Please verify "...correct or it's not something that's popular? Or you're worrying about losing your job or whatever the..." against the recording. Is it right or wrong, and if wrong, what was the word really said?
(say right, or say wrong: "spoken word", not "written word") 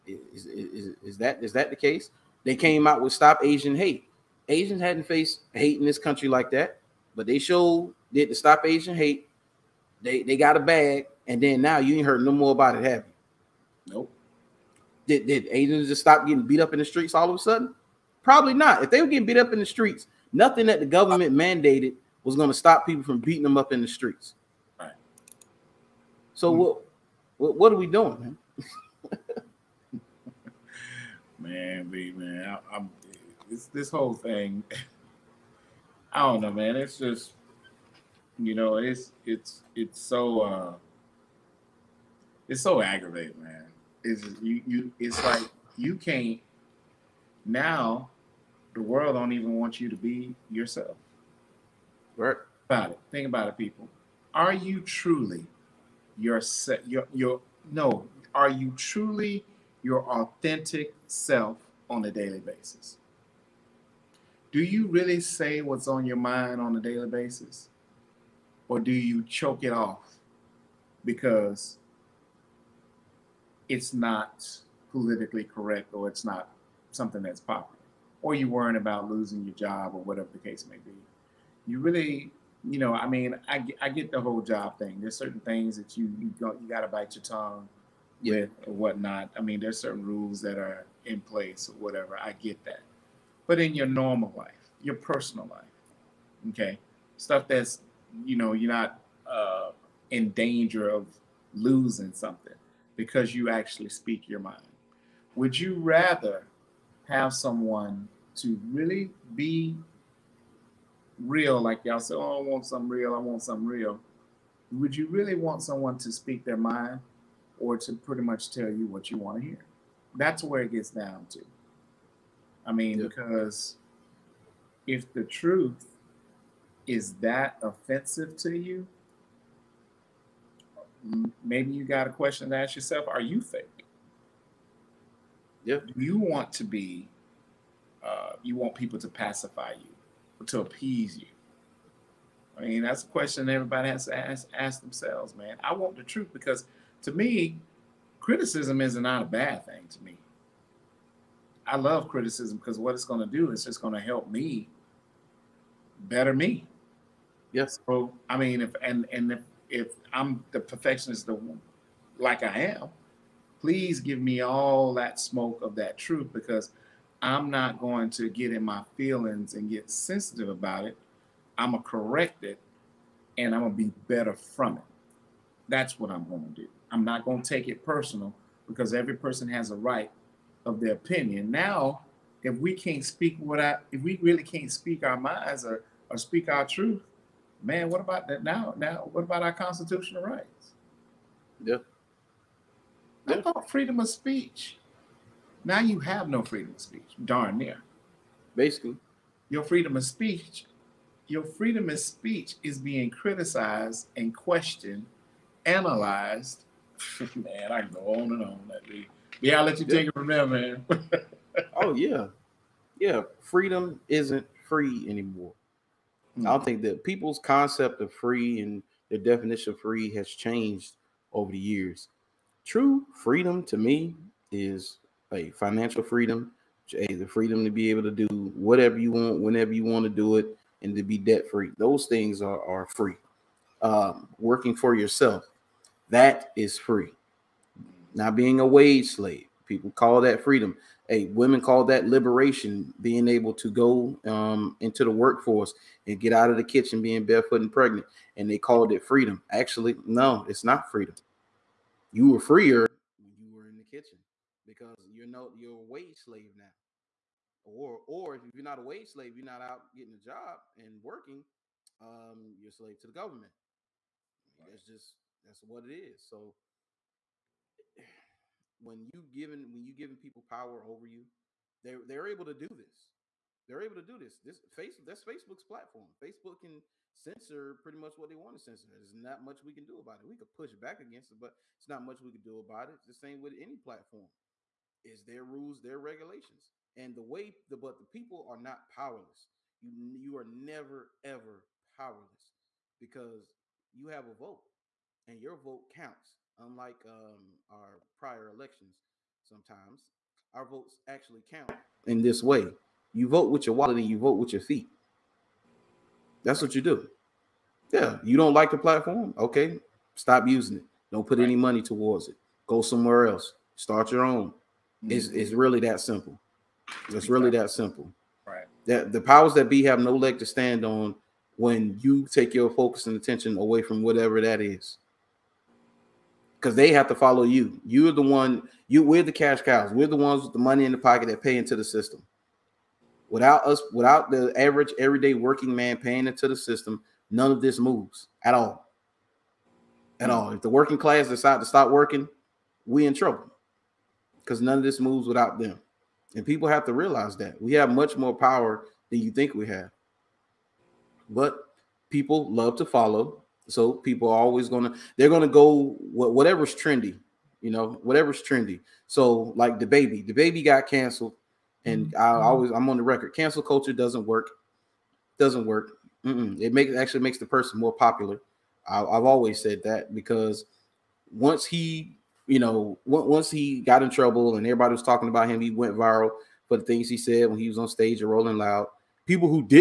right.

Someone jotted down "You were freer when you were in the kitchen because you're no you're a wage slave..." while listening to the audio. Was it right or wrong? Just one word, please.
right.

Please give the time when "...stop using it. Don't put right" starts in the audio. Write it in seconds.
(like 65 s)
310 s.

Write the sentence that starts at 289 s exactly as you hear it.
You you are never ever powerless because you have a vote, and your vote counts.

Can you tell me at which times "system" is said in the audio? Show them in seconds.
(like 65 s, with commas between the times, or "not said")
331 s, 336 s.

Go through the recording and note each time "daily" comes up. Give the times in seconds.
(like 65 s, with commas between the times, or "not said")
62 s, 66 s.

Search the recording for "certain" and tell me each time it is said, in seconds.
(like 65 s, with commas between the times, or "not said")
85 s, 89 s.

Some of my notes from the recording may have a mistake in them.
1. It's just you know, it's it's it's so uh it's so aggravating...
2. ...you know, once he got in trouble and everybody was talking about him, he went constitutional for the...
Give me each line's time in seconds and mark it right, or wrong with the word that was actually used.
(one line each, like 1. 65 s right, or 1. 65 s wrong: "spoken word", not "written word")
1. 36 s right
2. 372 s wrong: "viral", not "constitutional".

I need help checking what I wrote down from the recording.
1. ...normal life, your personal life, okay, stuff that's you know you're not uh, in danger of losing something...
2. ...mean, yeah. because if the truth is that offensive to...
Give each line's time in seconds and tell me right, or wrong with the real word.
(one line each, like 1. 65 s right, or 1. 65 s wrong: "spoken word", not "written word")
1. 93 s right
2. 122 s right.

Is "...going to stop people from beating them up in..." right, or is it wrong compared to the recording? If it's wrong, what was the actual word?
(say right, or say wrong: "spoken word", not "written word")
right.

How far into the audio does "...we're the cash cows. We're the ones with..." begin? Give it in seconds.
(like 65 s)
329 s.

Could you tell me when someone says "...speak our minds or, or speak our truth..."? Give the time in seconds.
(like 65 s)
184 s.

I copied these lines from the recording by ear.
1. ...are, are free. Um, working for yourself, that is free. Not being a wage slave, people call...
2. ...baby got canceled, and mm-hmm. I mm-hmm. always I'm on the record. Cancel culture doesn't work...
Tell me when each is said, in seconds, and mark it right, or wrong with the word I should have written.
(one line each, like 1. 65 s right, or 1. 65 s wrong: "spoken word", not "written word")
1. 232 s right
2. 360 s right.